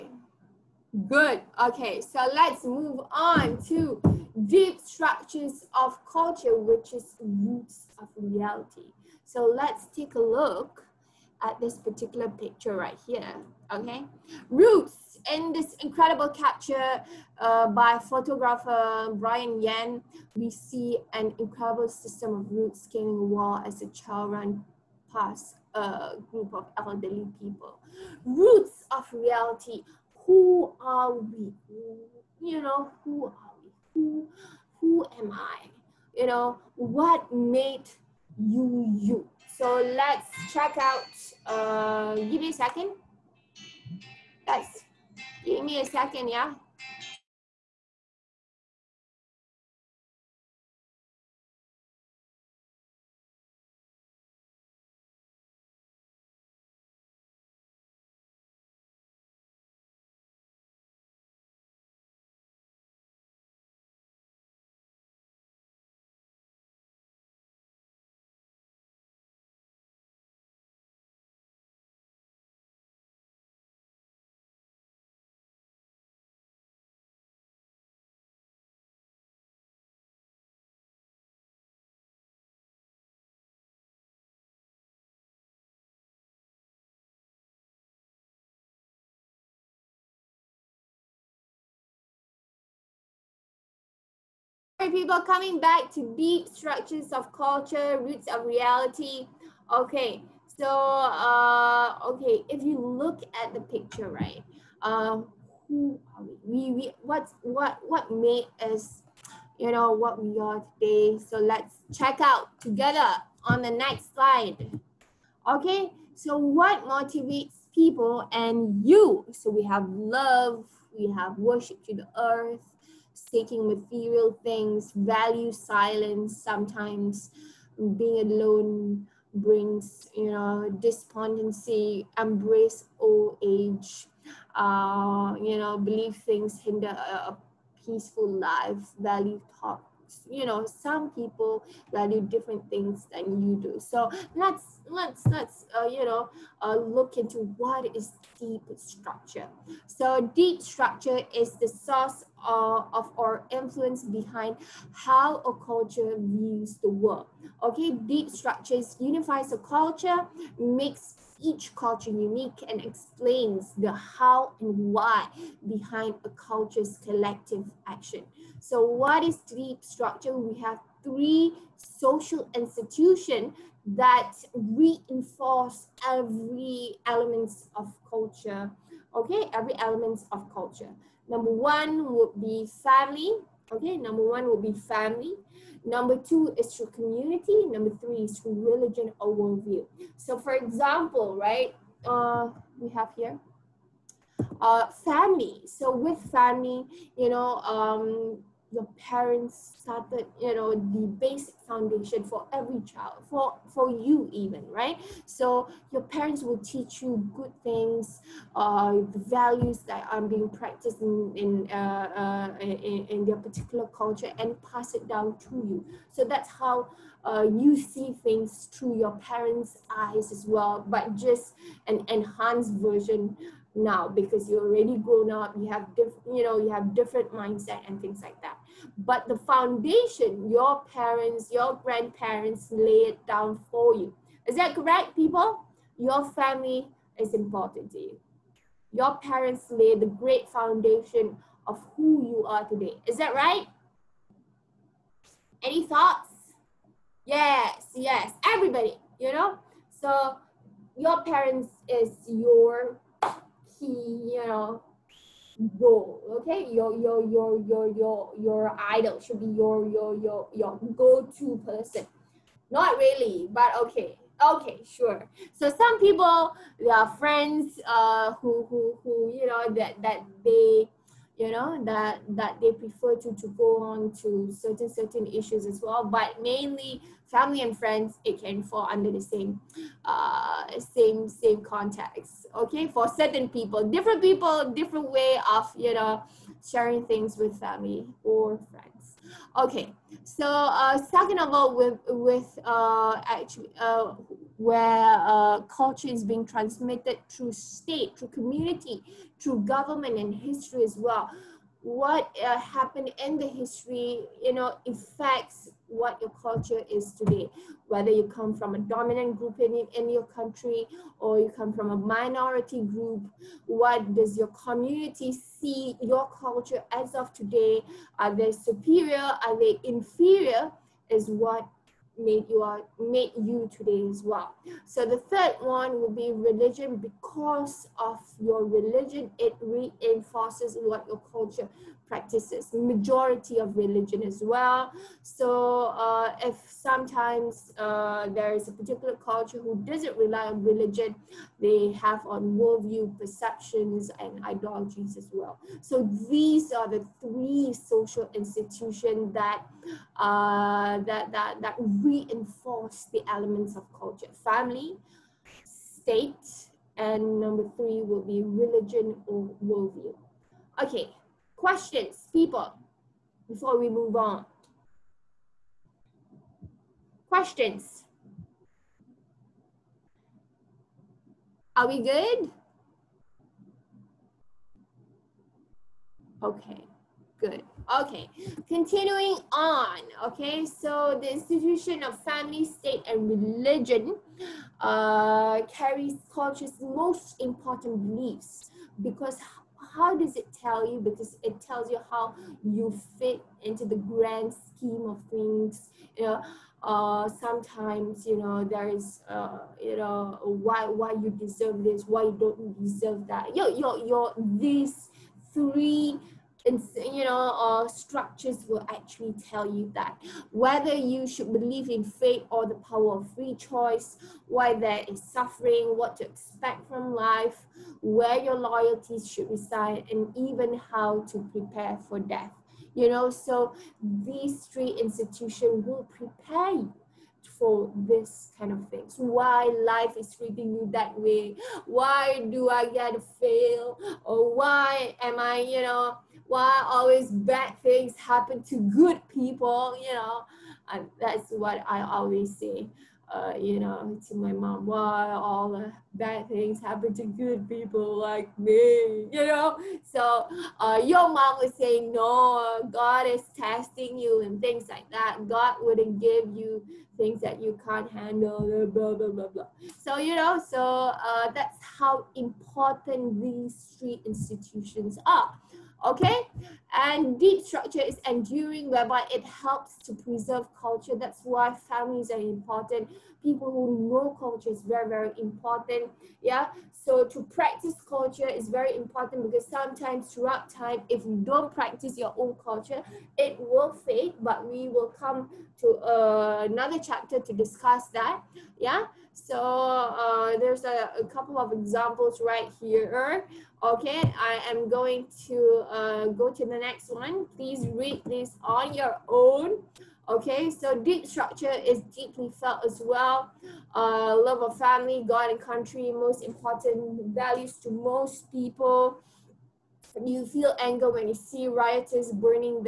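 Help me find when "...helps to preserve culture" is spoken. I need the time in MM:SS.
07:49.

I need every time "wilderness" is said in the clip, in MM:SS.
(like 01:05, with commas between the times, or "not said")
not said.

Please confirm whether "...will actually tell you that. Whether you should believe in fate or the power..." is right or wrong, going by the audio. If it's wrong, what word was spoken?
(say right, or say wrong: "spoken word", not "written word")
right.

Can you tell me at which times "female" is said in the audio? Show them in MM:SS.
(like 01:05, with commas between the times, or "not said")
not said.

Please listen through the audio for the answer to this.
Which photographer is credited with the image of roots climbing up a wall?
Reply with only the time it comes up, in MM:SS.
00:19.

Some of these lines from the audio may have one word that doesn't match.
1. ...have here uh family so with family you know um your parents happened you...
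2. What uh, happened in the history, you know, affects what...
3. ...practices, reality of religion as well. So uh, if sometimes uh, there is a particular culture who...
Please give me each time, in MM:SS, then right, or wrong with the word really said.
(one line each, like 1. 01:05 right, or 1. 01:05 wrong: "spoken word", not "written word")
1. 03:12 wrong: "started", not "happened"
2. 05:01 right
3. 05:32 wrong: "majority", not "reality".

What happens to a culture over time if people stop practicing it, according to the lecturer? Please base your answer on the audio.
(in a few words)
it will fade.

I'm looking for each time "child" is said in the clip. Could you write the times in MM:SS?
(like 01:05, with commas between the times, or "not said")
00:23, 03:22.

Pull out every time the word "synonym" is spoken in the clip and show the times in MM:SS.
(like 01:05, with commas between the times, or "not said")
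not said.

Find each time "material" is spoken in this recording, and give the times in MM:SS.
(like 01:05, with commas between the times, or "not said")
02:03.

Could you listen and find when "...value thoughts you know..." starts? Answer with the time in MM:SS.
02:18.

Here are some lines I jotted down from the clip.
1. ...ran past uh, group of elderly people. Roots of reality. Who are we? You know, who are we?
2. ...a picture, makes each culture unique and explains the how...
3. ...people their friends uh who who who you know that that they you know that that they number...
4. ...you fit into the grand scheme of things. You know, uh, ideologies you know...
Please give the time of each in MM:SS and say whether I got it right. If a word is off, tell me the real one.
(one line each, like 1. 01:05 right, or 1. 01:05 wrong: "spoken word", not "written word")
1. 00:24 right
2. 02:39 wrong: "culture", not "picture"
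3. 04:25 wrong: "prefer", not "number"
4. 06:32 wrong: "sometimes", not "ideologies".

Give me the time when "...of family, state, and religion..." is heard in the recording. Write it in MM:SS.
06:22.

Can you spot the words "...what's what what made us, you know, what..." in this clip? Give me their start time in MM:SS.
01:47.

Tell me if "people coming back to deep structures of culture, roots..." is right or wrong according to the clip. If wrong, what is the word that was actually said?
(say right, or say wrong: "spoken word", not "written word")
right.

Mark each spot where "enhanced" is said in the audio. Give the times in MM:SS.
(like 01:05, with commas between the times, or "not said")
03:42.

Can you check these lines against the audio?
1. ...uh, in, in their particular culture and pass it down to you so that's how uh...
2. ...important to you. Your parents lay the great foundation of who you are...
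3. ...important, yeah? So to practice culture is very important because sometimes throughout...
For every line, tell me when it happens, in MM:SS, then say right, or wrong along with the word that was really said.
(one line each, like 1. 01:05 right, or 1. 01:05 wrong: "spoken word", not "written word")
1. 03:32 right
2. 03:57 right
3. 07:55 right.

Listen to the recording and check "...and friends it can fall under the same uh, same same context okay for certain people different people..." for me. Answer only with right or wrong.
right.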